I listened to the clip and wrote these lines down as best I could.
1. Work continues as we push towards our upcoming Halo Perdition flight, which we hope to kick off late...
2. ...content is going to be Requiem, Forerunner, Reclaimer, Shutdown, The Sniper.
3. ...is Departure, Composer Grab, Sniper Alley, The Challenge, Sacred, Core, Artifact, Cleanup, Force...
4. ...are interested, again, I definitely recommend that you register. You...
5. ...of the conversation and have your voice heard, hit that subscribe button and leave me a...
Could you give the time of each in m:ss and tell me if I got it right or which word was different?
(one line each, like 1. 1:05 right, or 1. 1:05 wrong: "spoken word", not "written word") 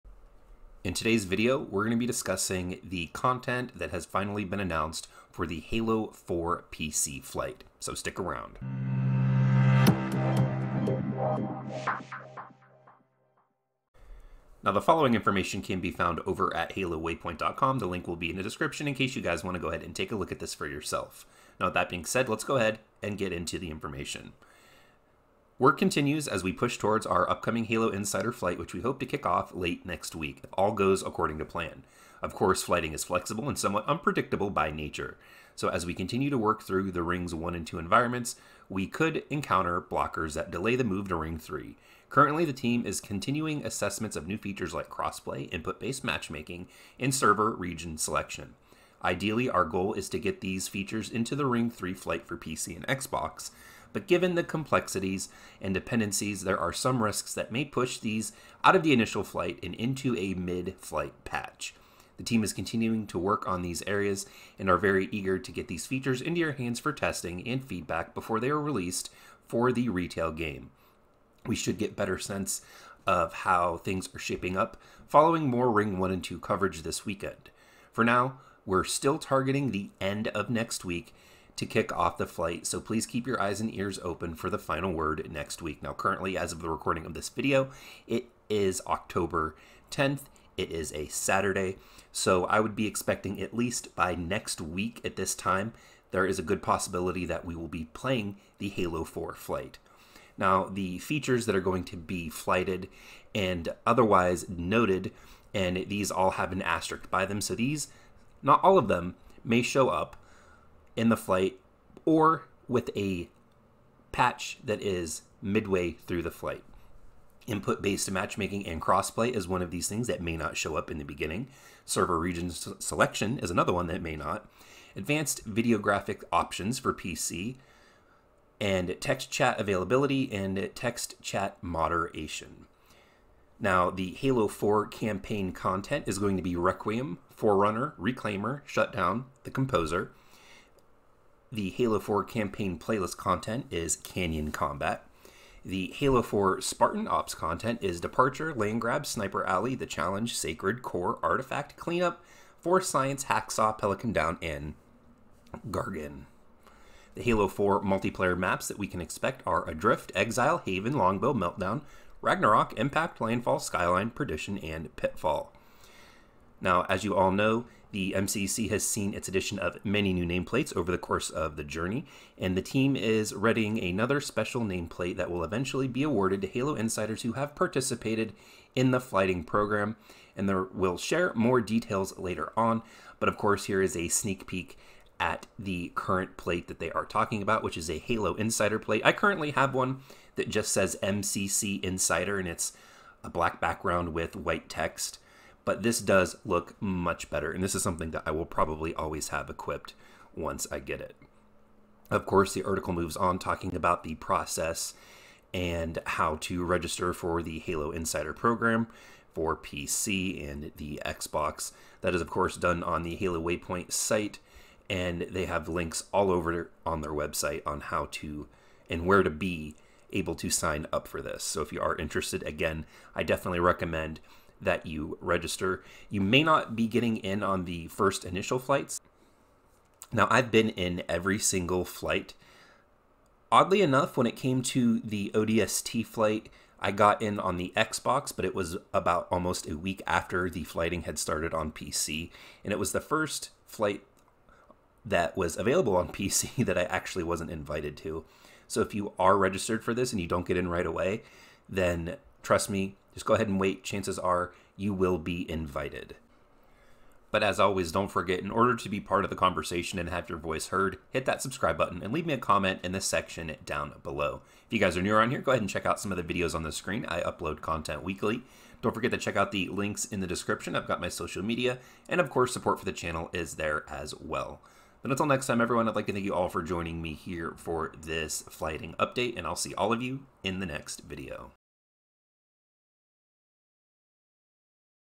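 1. 0:25 wrong: "Insider", not "Perdition"
2. 2:15 wrong: "Composer", not "Sniper"
3. 2:27 wrong: "Land", not "Composer"
4. 3:41 right
5. 4:19 right.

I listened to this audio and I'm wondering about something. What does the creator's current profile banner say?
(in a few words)
MCC Insider.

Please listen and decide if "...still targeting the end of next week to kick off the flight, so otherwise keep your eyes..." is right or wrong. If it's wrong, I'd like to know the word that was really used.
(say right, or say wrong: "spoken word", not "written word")
wrong: "please", not "otherwise".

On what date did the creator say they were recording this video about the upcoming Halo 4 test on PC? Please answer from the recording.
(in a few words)
October 10th.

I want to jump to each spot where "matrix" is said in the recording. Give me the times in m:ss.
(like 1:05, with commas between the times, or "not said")
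not said.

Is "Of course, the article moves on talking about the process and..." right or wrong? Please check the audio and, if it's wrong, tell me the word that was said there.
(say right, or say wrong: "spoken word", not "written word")
right.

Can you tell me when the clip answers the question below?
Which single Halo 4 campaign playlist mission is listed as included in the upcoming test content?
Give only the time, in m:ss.
2:23.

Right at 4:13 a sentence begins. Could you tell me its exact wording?
Chances are you will be invited.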